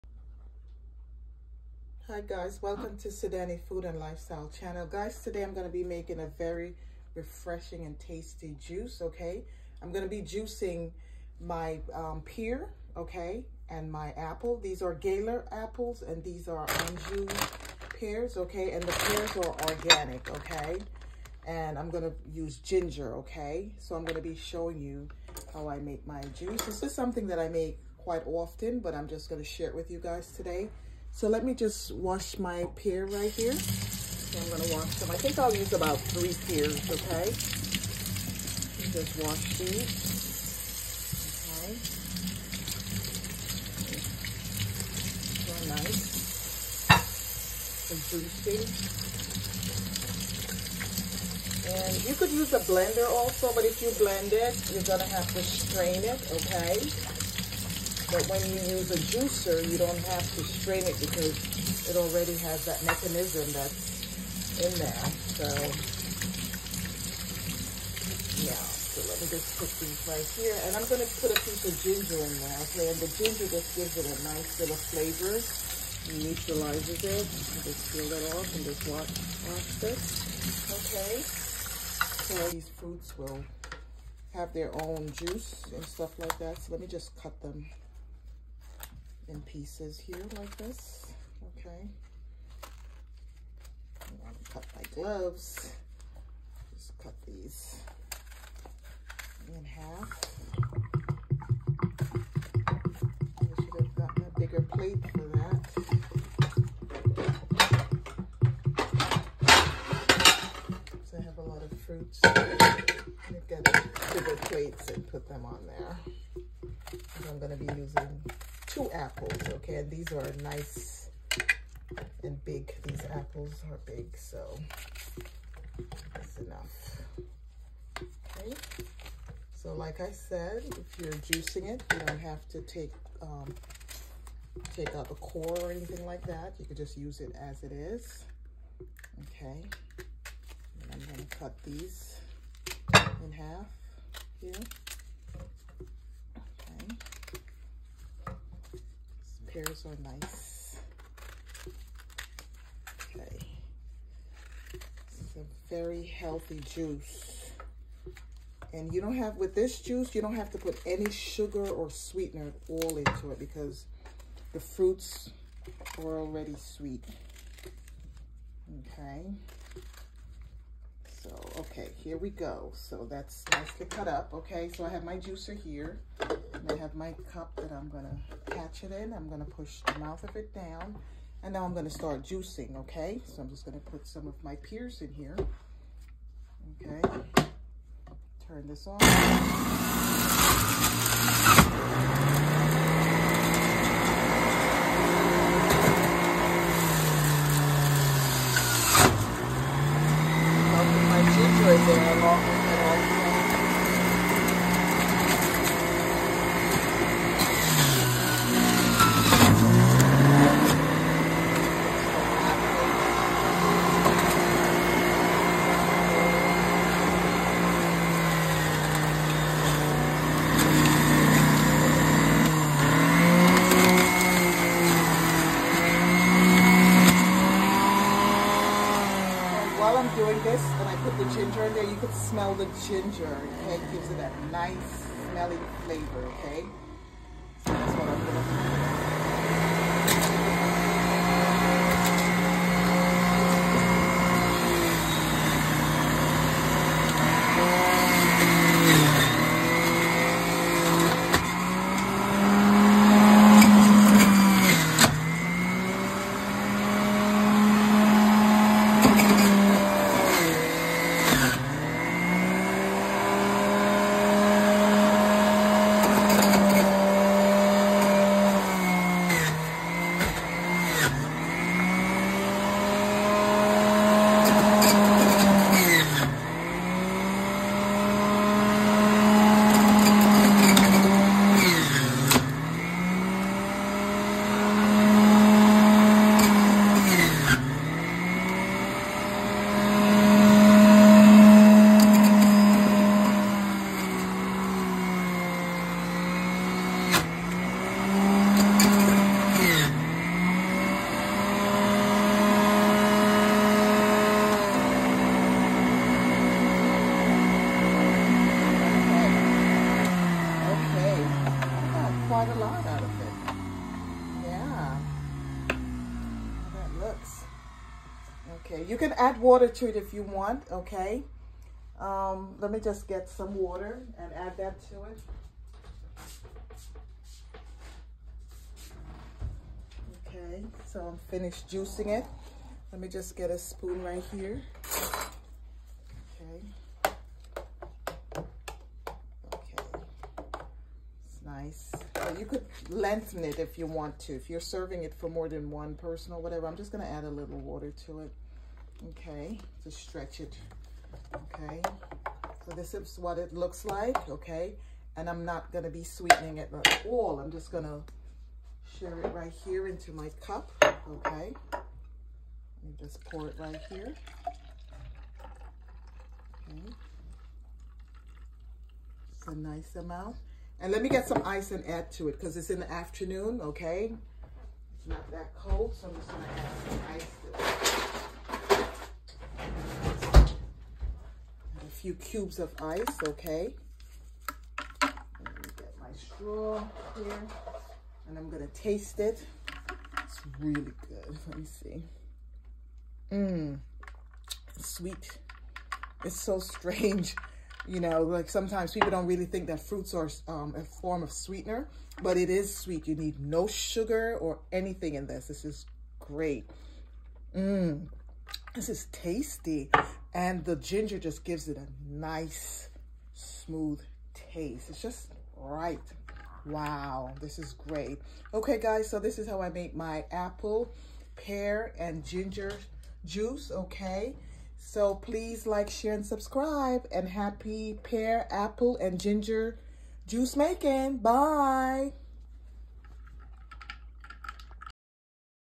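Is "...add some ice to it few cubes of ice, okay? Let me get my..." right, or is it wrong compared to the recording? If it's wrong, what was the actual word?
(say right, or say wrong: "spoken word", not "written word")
right.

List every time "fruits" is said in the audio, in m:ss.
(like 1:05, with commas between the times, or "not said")
1:22, 1:51, 2:44, 6:39.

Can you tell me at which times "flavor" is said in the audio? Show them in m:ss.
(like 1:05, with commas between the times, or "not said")
1:14, 3:55.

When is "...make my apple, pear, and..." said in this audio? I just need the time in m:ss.
6:59.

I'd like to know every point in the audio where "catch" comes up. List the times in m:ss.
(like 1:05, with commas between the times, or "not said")
2:58.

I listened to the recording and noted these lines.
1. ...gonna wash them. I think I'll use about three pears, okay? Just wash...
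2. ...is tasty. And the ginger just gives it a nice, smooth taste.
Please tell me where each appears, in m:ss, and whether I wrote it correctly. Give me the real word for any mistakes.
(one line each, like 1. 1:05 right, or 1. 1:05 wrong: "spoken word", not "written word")
1. 0:34 right
2. 6:48 right.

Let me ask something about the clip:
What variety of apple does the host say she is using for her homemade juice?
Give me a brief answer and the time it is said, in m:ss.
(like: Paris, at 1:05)
Gala, at 0:14.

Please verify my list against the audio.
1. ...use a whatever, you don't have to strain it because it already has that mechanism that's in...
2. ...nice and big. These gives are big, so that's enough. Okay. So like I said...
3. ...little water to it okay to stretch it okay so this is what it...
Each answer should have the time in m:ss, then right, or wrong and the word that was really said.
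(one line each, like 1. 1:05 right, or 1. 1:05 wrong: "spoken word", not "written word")
1. 0:58 wrong: "juicer", not "whatever"
2. 2:00 wrong: "apples", not "gives"
3. 5:47 right.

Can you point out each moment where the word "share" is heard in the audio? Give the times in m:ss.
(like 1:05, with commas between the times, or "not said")
0:29, 5:58, 7:05.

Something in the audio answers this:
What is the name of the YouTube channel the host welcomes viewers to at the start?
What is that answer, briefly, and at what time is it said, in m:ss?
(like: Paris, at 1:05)
Sydannie food and lifestyle, at 0:03.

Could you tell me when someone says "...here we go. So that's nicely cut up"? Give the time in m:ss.
2:51.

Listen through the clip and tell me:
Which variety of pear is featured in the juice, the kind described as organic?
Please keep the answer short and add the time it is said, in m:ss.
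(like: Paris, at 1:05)
Anjou, at 0:16.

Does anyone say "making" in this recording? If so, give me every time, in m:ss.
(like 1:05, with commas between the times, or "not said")
0:05, 7:10.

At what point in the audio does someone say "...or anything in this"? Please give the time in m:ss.
6:44.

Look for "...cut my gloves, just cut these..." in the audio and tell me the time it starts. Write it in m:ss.
1:34.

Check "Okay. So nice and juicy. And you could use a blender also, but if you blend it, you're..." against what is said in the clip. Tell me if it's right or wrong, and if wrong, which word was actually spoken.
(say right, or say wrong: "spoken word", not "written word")
right.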